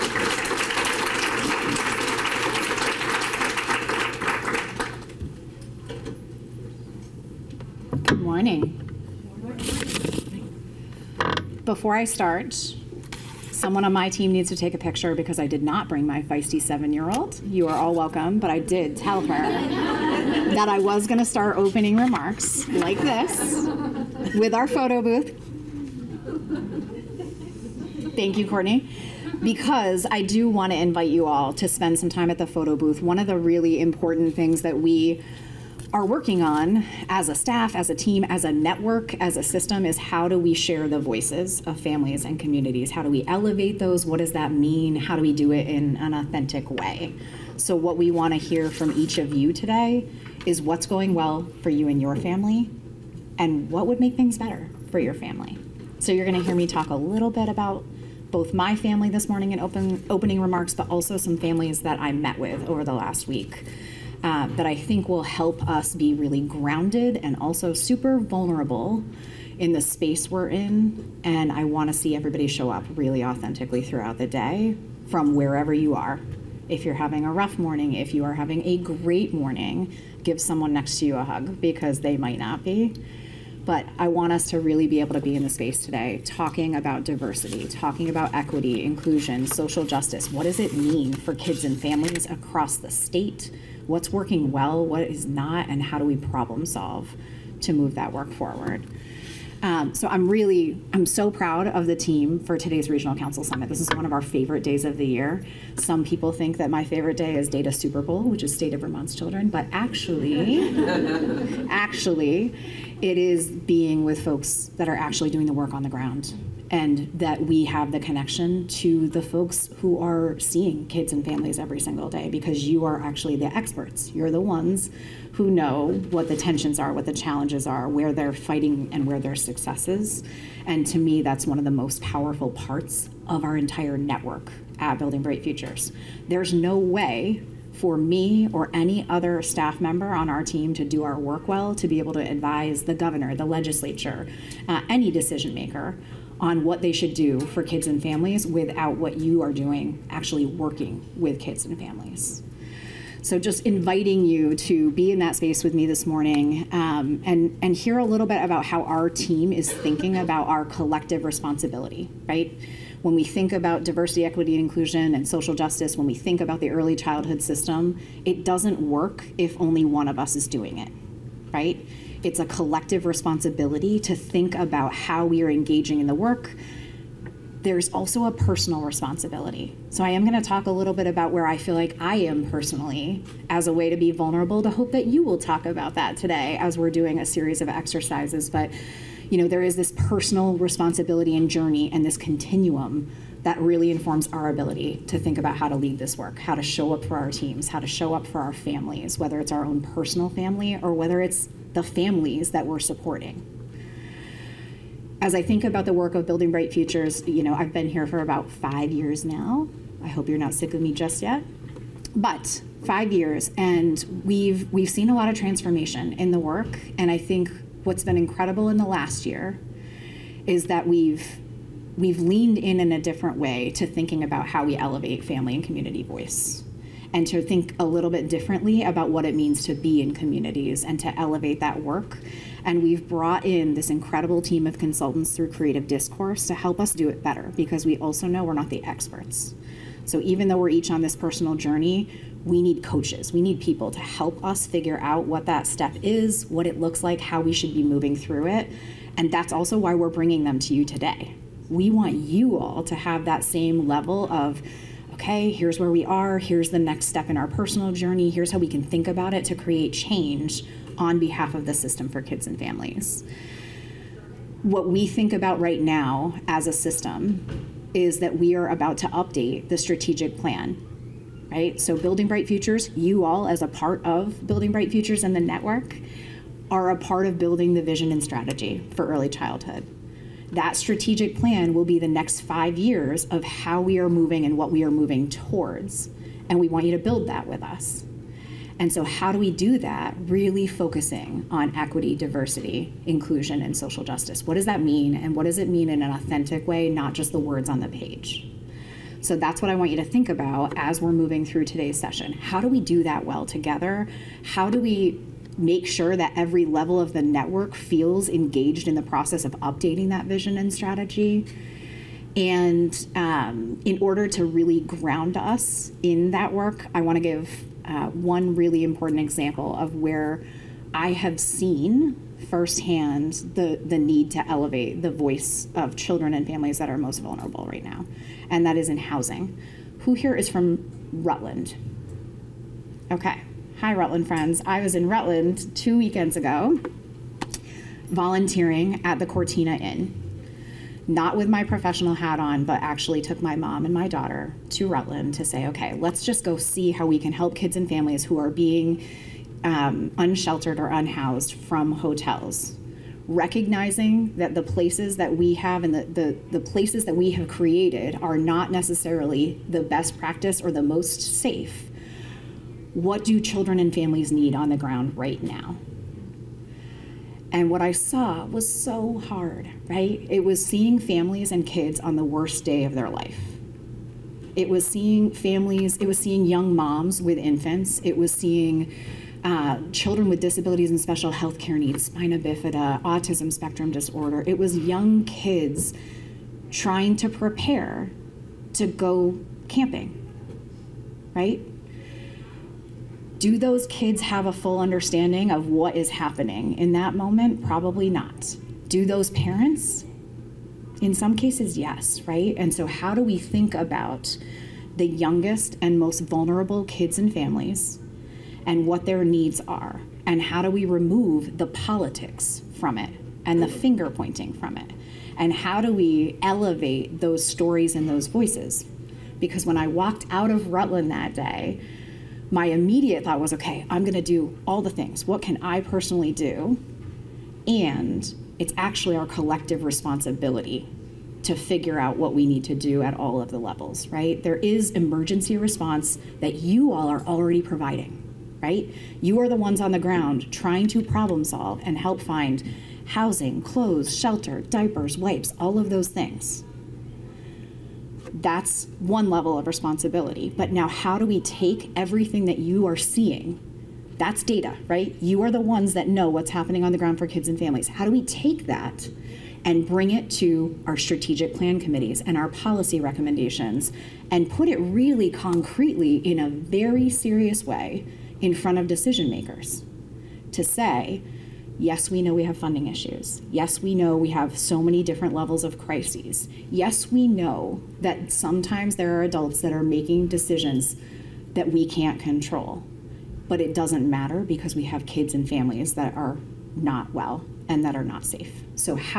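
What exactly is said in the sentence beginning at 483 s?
But it doesn't matter because we have kids and families that are not well and that are not safe.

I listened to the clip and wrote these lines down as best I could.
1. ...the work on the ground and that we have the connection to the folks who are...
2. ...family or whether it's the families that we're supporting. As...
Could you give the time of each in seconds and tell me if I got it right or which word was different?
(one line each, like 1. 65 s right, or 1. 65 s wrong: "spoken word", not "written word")
1. 115 s right
2. 200 s right.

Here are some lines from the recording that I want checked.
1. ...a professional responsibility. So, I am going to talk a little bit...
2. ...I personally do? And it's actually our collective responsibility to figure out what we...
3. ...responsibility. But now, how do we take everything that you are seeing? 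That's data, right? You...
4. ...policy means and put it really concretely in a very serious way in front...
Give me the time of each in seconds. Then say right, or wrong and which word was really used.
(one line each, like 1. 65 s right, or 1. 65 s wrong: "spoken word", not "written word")
1. 178 s wrong: "personal", not "professional"
2. 425 s right
3. 449 s right
4. 462 s wrong: "recommendations", not "means".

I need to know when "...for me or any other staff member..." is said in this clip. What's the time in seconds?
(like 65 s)
137 s.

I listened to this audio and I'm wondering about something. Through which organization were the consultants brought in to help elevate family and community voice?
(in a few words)
Creative Discourse.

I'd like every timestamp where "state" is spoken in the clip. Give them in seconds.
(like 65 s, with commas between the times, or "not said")
92 s, 108 s.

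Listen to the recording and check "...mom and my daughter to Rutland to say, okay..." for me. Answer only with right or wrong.
right.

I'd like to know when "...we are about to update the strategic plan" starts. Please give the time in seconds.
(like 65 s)
268 s.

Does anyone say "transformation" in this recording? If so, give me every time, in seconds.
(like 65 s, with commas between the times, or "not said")
215 s.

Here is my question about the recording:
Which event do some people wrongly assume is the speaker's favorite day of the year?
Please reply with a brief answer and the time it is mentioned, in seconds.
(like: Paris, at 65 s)
Data Super Bowl, at 107 s.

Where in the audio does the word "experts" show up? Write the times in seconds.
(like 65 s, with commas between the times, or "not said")
123 s, 238 s.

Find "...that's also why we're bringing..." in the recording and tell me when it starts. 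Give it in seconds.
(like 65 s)
249 s.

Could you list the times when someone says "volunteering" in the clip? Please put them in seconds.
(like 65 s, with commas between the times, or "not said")
338 s.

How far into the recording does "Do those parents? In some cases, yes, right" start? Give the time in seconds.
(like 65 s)
398 s.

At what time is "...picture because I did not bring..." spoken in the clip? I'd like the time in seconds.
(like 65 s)
14 s.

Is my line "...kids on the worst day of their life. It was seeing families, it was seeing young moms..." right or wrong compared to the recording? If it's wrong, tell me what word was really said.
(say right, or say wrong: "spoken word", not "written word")
right.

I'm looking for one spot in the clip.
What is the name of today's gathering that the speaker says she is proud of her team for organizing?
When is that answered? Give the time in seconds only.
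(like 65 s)
102 s.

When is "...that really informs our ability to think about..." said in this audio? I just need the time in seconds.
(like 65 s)
193 s.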